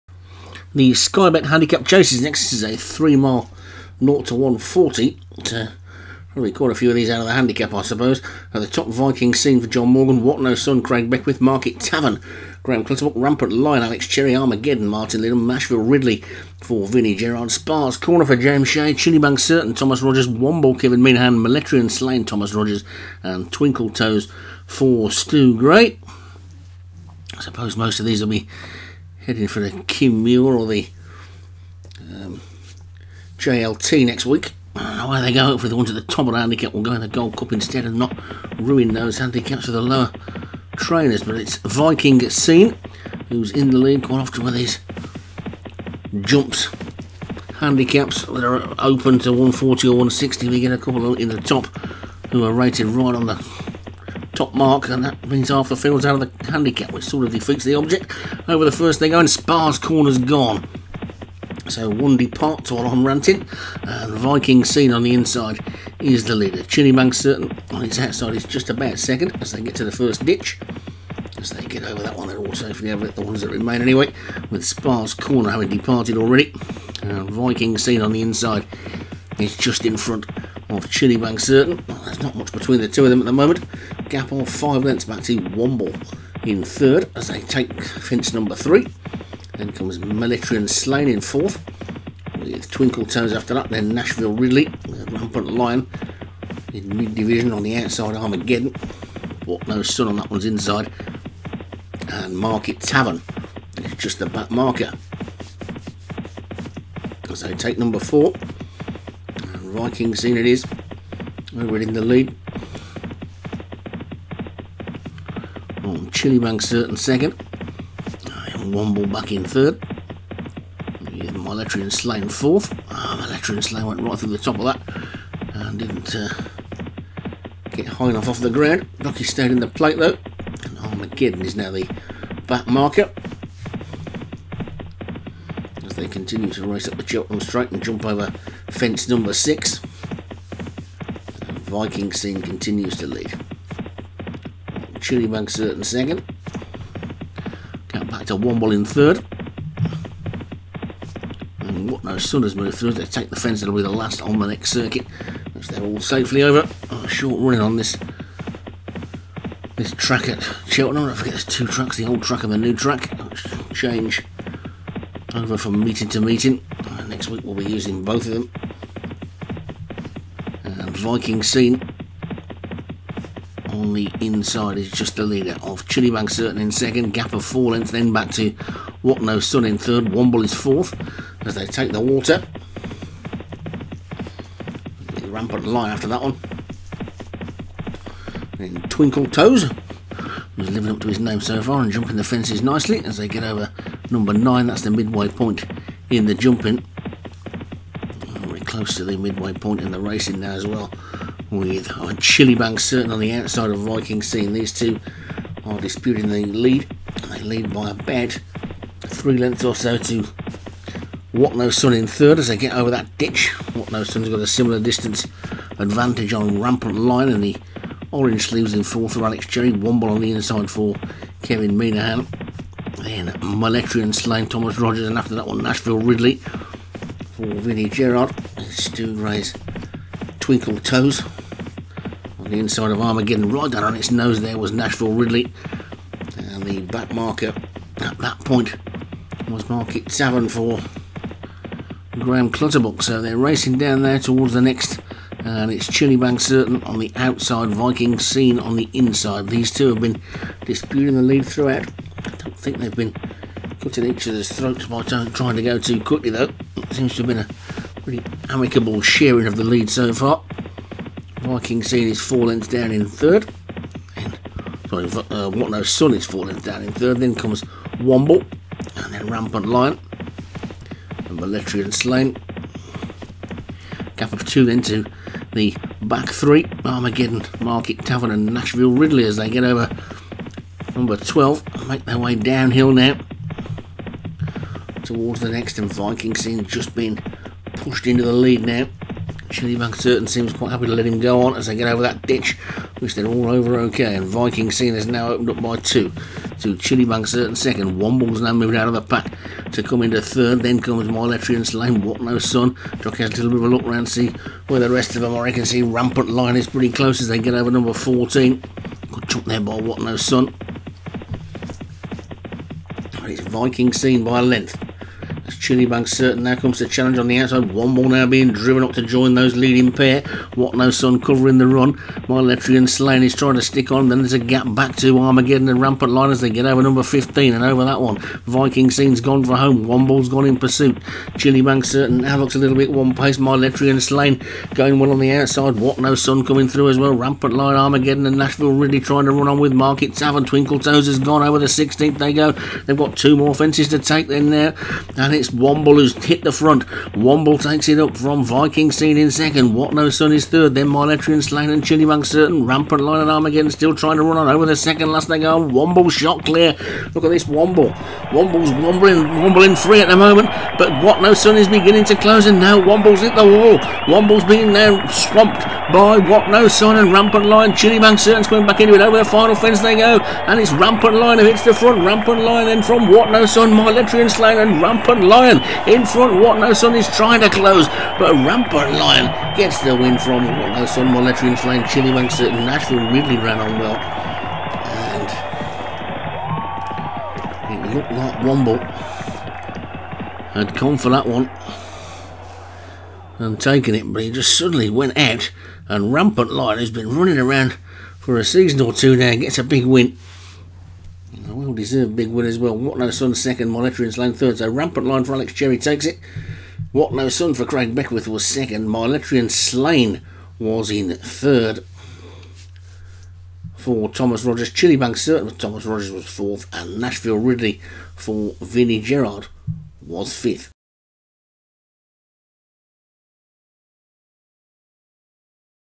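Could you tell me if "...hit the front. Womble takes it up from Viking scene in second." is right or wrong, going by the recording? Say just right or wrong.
right.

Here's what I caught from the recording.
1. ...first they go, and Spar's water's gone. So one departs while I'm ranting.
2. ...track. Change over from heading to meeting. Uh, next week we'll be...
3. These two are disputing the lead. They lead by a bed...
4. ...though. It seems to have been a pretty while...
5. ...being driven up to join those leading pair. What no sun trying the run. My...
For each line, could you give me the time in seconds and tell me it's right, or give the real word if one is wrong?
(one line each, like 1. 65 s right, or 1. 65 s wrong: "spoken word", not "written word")
1. 58 s wrong: "corner", not "water"
2. 162 s wrong: "meeting", not "heading"
3. 204 s right
4. 256 s wrong: "amicable", not "while"
5. 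318 s wrong: "covering", not "trying".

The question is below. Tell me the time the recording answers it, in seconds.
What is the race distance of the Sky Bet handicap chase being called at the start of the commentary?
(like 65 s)
2 s.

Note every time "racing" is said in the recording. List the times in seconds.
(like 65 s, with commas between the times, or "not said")
199 s, 243 s.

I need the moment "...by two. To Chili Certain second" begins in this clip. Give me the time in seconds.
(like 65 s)
295 s.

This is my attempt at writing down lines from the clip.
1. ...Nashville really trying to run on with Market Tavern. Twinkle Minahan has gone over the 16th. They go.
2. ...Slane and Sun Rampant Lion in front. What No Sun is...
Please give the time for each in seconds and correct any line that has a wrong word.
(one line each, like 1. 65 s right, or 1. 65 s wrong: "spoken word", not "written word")
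1. 338 s wrong: "Toes", not "Minahan"
2. 374 s wrong: "Rampant", not "Sun".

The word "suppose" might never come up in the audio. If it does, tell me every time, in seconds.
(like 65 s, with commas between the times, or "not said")
7 s, 27 s.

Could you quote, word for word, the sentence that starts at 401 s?
Well deserved big win as well.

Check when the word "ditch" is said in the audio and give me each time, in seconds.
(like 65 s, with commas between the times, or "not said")
70 s, 213 s, 292 s.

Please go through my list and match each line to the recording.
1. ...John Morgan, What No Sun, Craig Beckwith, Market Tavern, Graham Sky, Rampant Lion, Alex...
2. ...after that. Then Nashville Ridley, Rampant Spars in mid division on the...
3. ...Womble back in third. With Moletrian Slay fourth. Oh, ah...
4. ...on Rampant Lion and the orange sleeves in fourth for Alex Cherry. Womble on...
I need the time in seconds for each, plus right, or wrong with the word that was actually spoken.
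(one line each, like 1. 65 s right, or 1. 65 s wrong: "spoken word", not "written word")
1. 9 s wrong: "Clutterbuck", not "Sky"
2. 93 s wrong: "Lion", not "Spars"
3. 118 s right
4. 216 s right.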